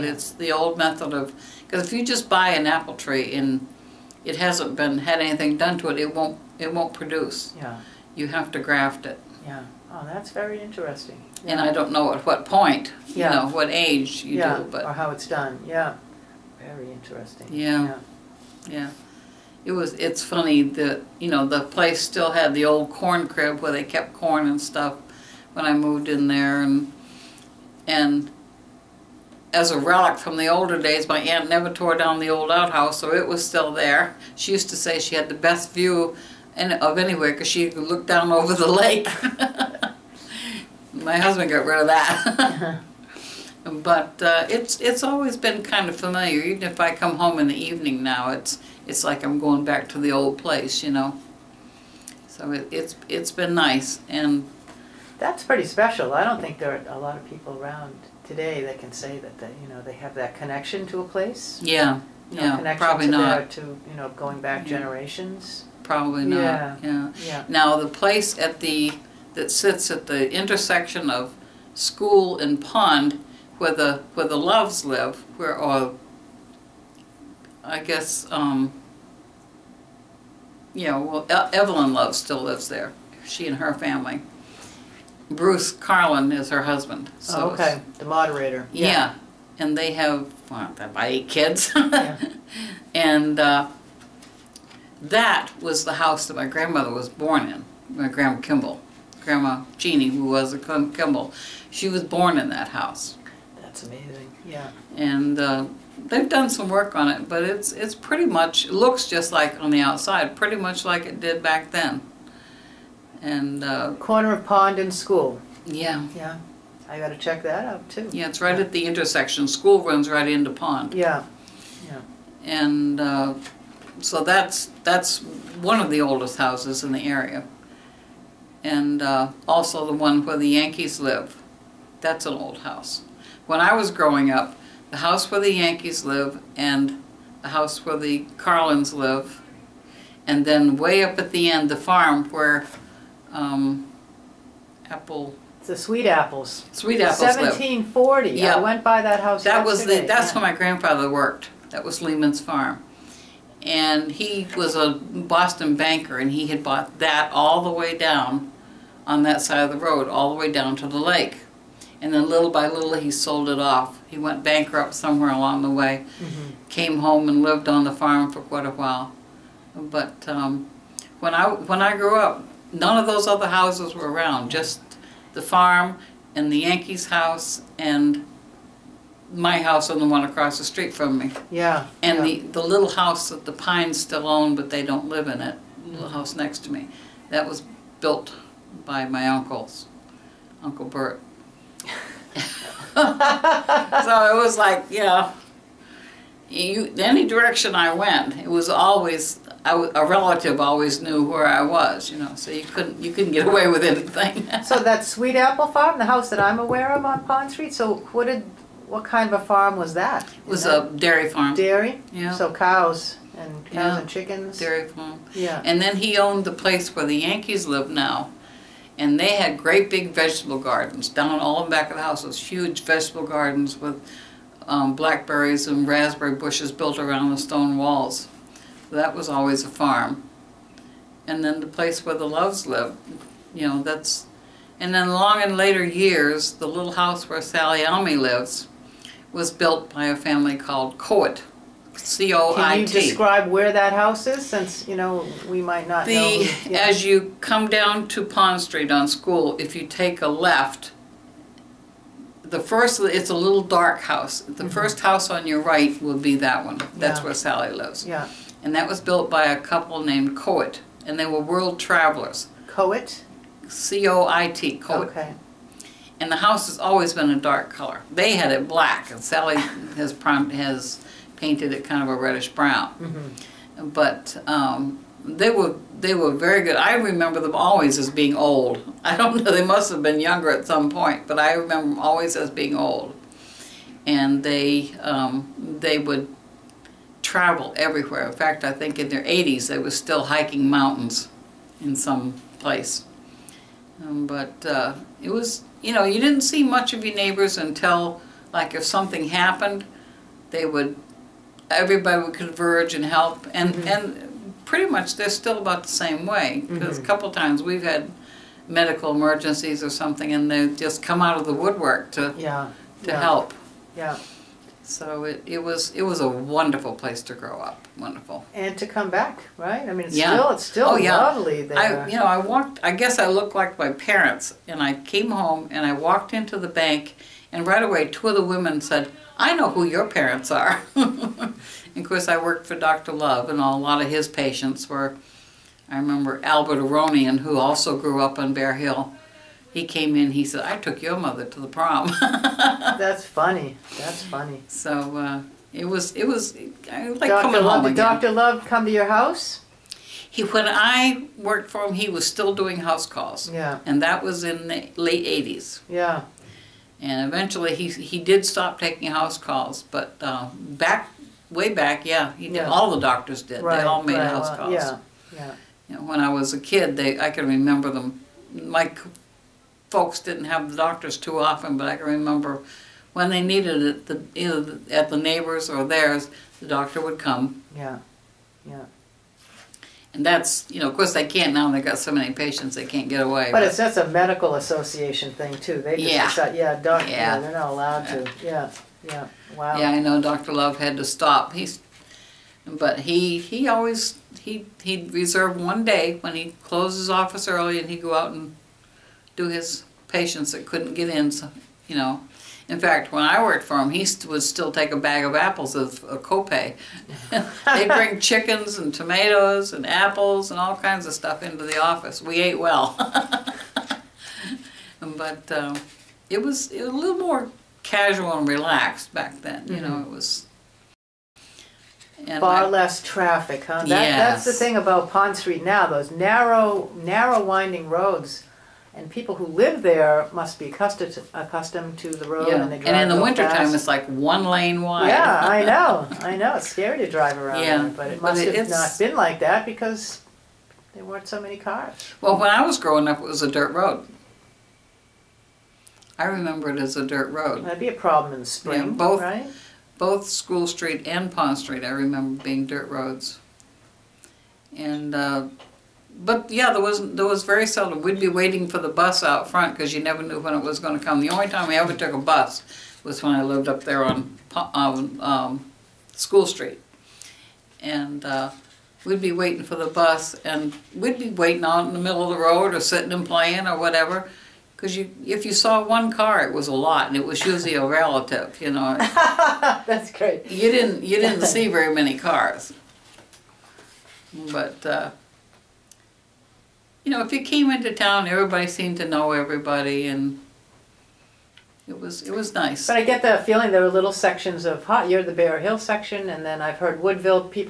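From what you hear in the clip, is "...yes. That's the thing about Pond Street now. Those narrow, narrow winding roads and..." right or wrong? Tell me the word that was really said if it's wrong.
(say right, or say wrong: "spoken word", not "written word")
right.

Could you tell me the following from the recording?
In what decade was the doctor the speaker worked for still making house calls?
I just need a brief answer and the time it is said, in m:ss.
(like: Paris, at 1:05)
Late 80s, at 5:54.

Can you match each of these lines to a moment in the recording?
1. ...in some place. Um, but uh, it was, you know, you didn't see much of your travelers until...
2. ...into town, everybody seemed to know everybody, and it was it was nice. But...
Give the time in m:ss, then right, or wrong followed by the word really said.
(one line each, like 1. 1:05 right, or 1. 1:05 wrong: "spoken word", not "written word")
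1. 4:51 wrong: "neighbors", not "travelers"
2. 8:07 right.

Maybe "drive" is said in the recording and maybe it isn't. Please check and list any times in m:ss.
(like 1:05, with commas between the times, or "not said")
7:12, 7:17.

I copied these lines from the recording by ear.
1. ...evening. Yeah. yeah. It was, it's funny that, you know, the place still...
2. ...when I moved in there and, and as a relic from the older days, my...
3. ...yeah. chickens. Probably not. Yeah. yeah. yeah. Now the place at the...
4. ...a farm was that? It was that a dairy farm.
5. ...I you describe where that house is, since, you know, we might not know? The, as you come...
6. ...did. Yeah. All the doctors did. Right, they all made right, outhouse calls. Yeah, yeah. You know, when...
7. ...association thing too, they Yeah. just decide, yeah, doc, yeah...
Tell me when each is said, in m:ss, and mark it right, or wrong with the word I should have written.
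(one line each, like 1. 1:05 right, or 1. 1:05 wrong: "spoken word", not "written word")
1. 0:16 wrong: "interesting", not "evening"
2. 0:25 right
3. 1:04 wrong: "generations", not "chickens"
4. 3:29 right
5. 4:02 right
6. 6:02 wrong: "house", not "outhouse"
7. 6:24 right.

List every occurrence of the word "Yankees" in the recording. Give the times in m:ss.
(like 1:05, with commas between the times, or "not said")
2:10, 2:15, 2:56, 3:37.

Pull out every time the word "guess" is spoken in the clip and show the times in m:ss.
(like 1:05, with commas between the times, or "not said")
1:17, 5:22.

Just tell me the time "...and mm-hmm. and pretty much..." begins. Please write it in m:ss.
5:03.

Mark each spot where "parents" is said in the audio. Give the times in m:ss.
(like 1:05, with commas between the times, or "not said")
5:23, 5:30.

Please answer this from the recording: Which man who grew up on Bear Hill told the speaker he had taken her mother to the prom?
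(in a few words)
Albert Aronian.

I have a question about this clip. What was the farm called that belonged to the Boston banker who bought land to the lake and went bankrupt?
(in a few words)
Lehman's farm.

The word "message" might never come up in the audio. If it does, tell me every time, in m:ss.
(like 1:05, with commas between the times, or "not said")
not said.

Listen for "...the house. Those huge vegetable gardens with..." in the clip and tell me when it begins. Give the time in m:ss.
3:41.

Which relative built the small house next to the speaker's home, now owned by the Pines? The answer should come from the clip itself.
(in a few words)
Uncle Bert.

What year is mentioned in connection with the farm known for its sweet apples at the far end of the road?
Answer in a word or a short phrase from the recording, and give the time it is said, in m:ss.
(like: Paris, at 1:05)
1740, at 2:27.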